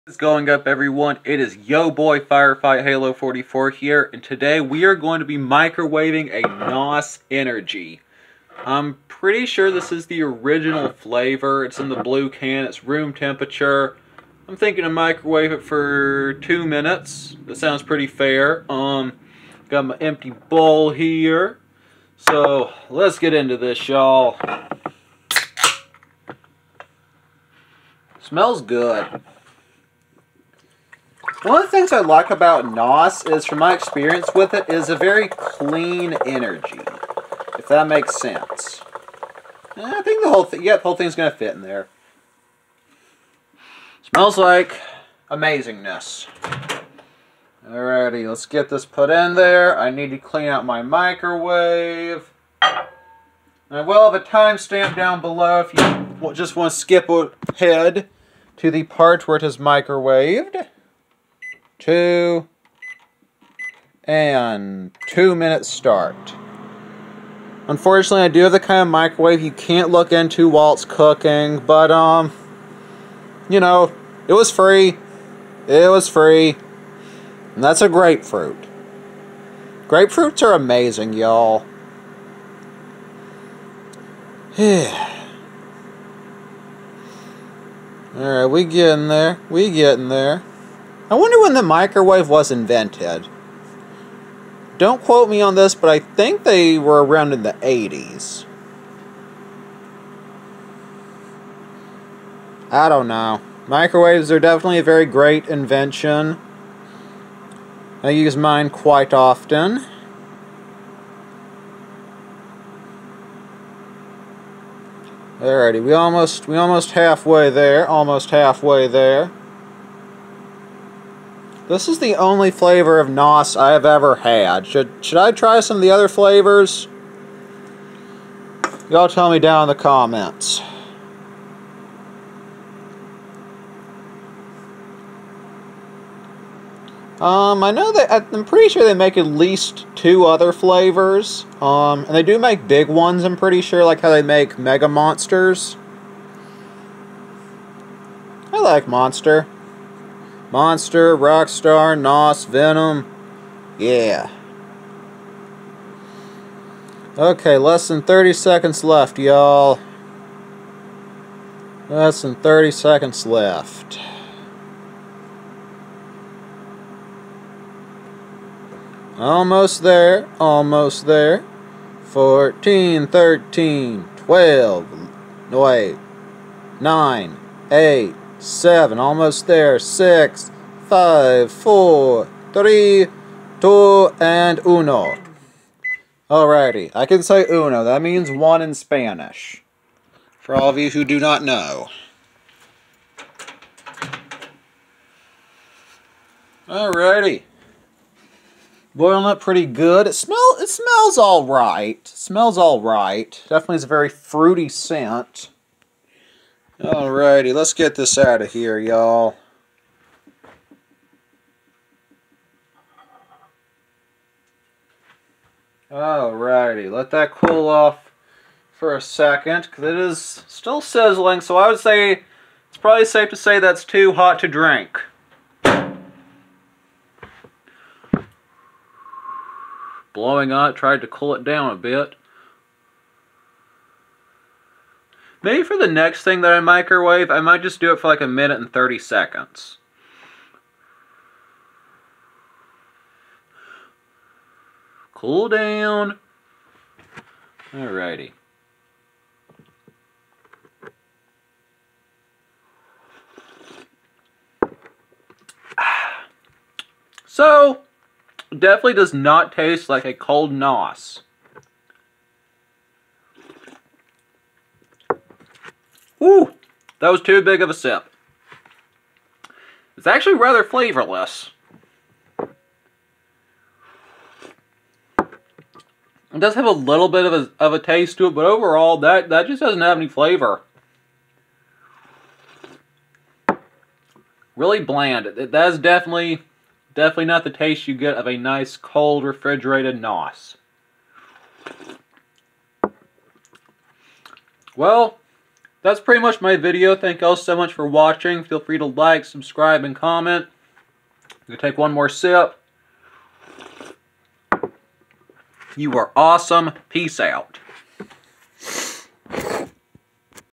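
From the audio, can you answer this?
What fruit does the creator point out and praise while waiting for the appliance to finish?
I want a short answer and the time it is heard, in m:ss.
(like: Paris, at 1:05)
Grapefruit, at 1:17.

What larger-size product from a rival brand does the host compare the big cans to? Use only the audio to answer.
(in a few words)
Mega Monsters.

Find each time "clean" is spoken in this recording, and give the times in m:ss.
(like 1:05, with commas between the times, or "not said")
0:35, 0:50.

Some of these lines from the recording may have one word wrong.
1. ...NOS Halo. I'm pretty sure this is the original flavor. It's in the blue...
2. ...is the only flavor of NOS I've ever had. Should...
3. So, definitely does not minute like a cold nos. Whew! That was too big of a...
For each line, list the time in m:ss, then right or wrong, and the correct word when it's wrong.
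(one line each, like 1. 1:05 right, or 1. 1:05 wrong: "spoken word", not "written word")
1. 0:06 wrong: "Energy", not "Halo"
2. 2:01 right
3. 4:17 wrong: "taste", not "minute".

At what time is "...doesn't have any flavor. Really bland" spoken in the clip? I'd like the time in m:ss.
4:39.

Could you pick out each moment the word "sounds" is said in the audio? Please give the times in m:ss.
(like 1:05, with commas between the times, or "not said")
0:17.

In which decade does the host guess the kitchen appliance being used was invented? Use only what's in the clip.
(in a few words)
The 80s.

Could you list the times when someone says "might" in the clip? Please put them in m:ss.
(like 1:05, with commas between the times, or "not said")
3:57.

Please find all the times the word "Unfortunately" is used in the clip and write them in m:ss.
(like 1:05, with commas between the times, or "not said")
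1:07.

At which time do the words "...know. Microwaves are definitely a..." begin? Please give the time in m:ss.
1:43.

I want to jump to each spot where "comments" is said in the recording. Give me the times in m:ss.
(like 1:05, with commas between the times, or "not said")
2:09, 4:59.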